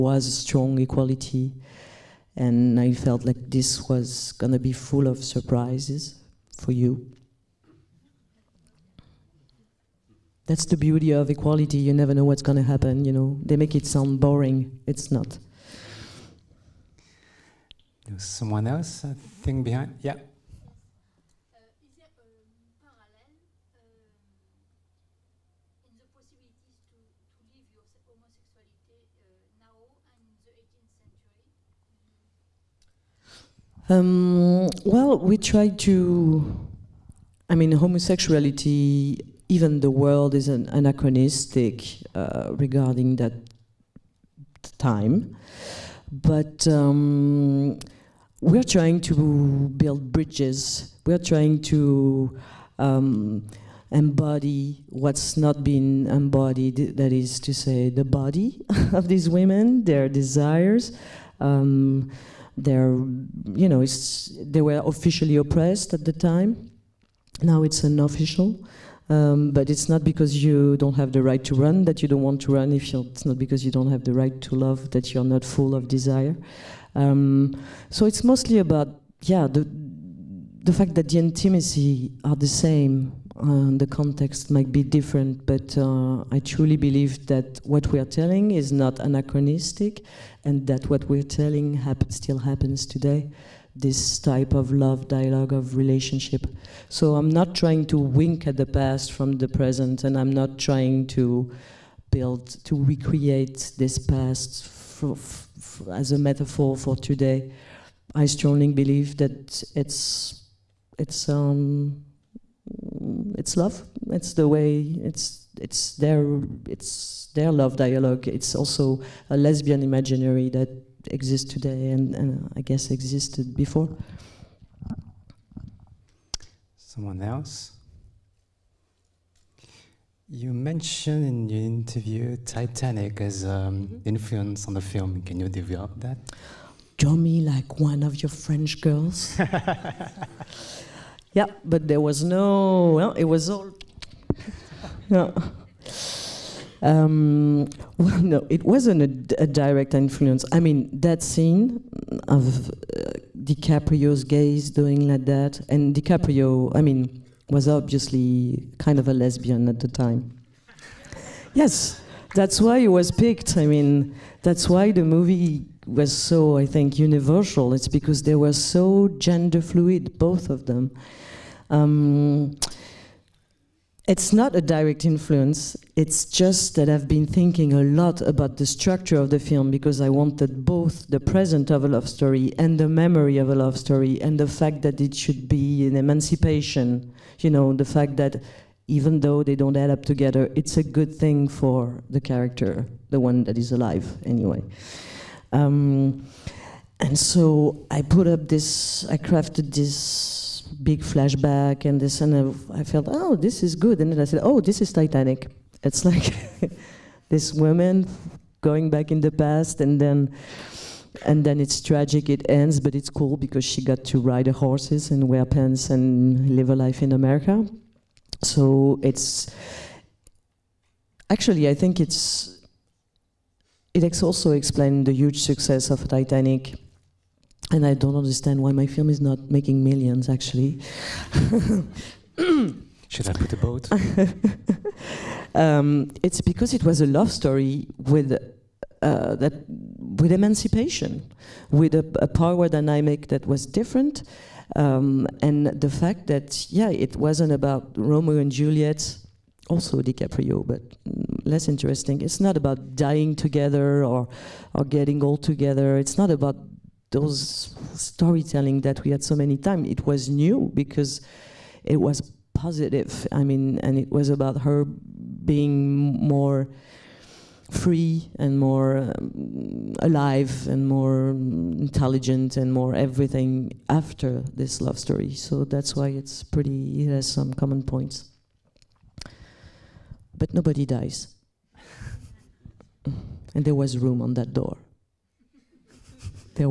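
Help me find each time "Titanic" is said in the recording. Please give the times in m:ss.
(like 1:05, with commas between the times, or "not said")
2:12, 3:24, 3:46.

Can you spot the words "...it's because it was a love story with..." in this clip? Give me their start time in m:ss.
3:56.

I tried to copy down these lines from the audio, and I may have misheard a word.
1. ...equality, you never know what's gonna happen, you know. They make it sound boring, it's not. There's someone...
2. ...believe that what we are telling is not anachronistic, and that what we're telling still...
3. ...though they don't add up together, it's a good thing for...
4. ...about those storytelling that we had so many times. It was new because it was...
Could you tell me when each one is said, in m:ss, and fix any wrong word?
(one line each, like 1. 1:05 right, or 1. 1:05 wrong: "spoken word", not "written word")
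1. 0:11 right
2. 1:26 right
3. 3:09 right
4. 4:16 right.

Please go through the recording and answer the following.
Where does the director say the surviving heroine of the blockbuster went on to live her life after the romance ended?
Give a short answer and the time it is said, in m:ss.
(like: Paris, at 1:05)
America, at 3:37.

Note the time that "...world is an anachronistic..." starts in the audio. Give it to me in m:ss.
0:39.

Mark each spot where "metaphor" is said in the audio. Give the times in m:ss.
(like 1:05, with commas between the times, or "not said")
1:46.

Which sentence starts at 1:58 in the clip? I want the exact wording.
It's also a lesbian imaginary that exists today and, and uh, I guess existed before.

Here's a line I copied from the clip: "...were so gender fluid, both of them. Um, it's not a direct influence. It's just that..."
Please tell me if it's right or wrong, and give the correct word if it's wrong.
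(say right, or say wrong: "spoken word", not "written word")
right.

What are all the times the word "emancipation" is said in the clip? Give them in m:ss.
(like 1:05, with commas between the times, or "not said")
3:05, 4:00.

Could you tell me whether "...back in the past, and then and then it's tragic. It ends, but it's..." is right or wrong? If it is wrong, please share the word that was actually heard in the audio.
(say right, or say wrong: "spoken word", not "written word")
right.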